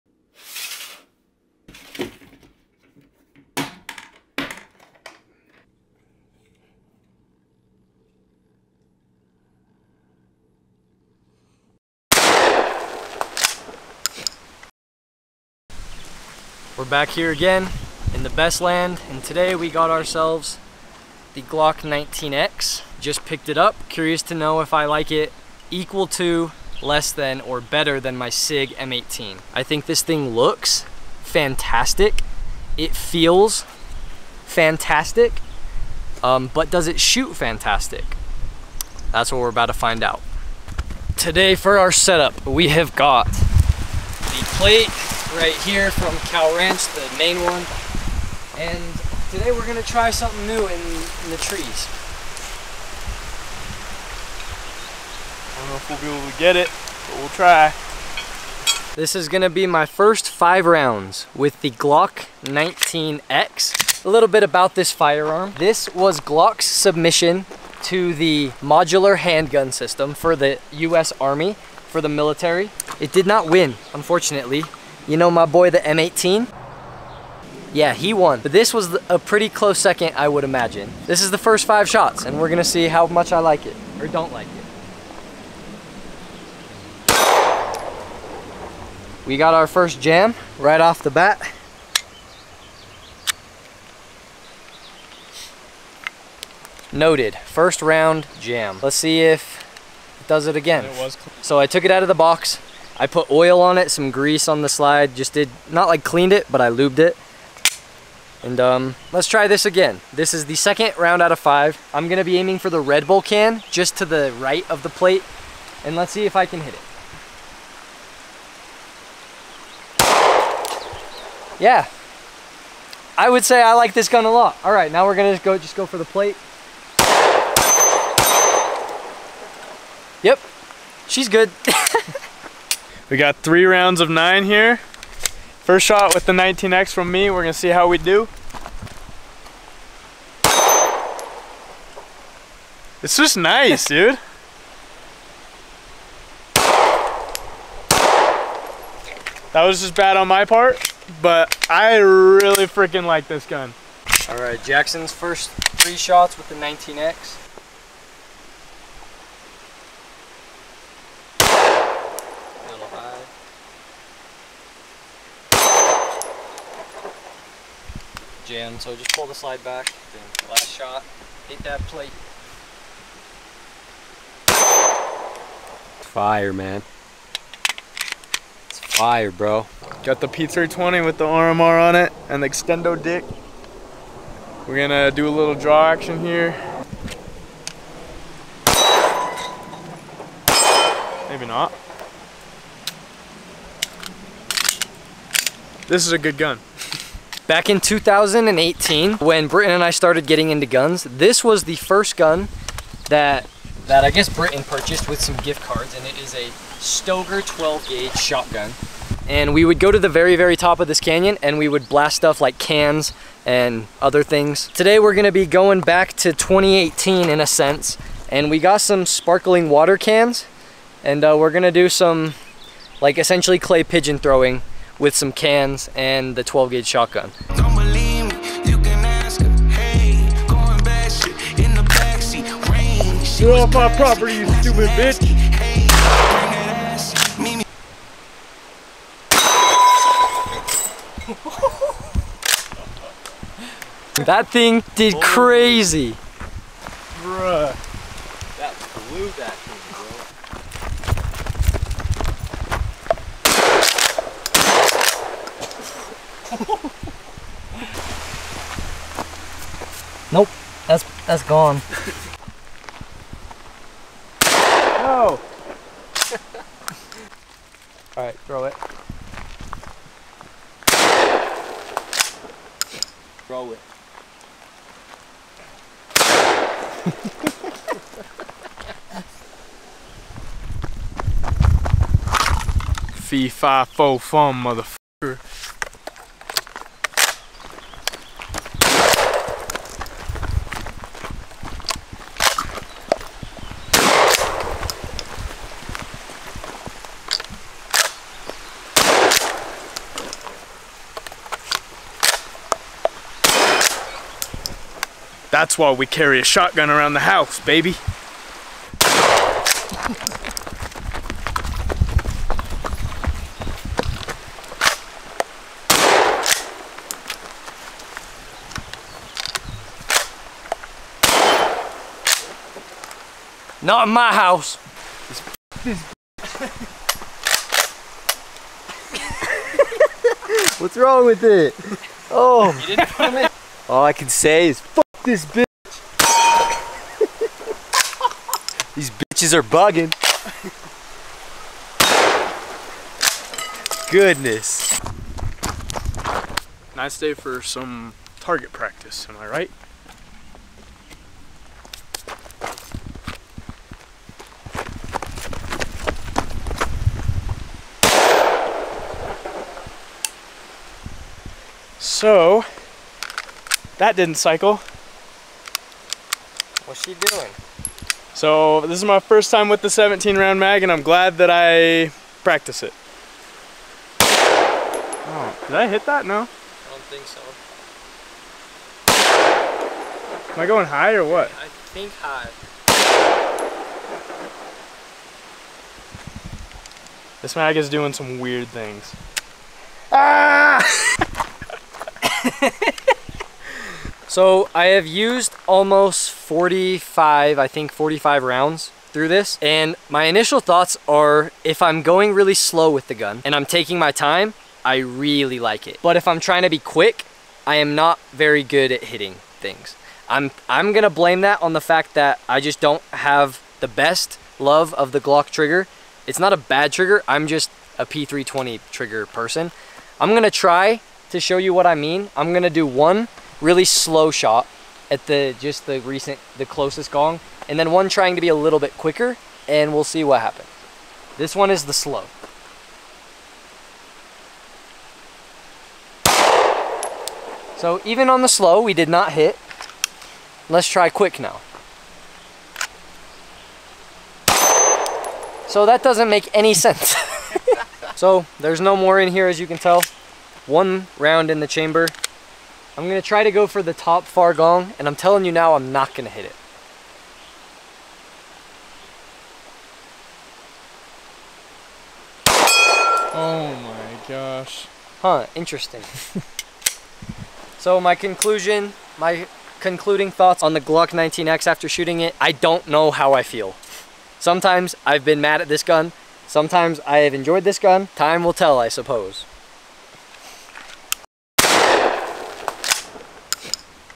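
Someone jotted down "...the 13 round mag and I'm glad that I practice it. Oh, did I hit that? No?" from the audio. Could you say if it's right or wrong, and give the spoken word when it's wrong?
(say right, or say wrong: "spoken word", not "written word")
wrong: "17", not "13".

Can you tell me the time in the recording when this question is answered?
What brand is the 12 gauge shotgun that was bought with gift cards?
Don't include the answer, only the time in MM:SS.
03:26.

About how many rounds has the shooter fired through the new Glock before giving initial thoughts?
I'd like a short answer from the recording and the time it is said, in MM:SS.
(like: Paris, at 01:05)
45, at 06:37.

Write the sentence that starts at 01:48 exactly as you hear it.
And um, let's try this again.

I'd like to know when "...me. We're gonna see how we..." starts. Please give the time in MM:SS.
02:17.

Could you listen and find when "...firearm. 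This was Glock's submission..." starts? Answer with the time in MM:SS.
01:04.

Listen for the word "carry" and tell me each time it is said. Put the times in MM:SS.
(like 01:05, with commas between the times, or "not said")
05:06.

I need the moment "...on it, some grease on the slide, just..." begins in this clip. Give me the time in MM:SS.
01:43.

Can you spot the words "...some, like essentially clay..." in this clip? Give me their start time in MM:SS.
03:41.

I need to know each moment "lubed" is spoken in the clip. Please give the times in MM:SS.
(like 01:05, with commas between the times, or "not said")
01:46.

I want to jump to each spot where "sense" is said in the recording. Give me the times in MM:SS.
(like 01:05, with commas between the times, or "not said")
03:37, 07:26.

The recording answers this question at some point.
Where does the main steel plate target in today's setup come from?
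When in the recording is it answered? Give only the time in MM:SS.
00:46.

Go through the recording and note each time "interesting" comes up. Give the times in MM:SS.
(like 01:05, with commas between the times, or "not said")
07:45.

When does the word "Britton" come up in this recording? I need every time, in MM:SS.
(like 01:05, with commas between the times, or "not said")
03:19, 03:24.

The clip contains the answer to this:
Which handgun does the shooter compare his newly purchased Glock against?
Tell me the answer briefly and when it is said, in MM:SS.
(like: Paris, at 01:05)
SIG M18, at 00:28.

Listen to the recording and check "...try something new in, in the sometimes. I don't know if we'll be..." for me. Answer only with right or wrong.
wrong.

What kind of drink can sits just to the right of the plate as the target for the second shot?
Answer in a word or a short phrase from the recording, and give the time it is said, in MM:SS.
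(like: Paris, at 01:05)
Red Bull, at 01:52.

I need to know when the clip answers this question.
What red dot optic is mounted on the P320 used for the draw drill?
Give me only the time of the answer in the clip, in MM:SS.
03:01.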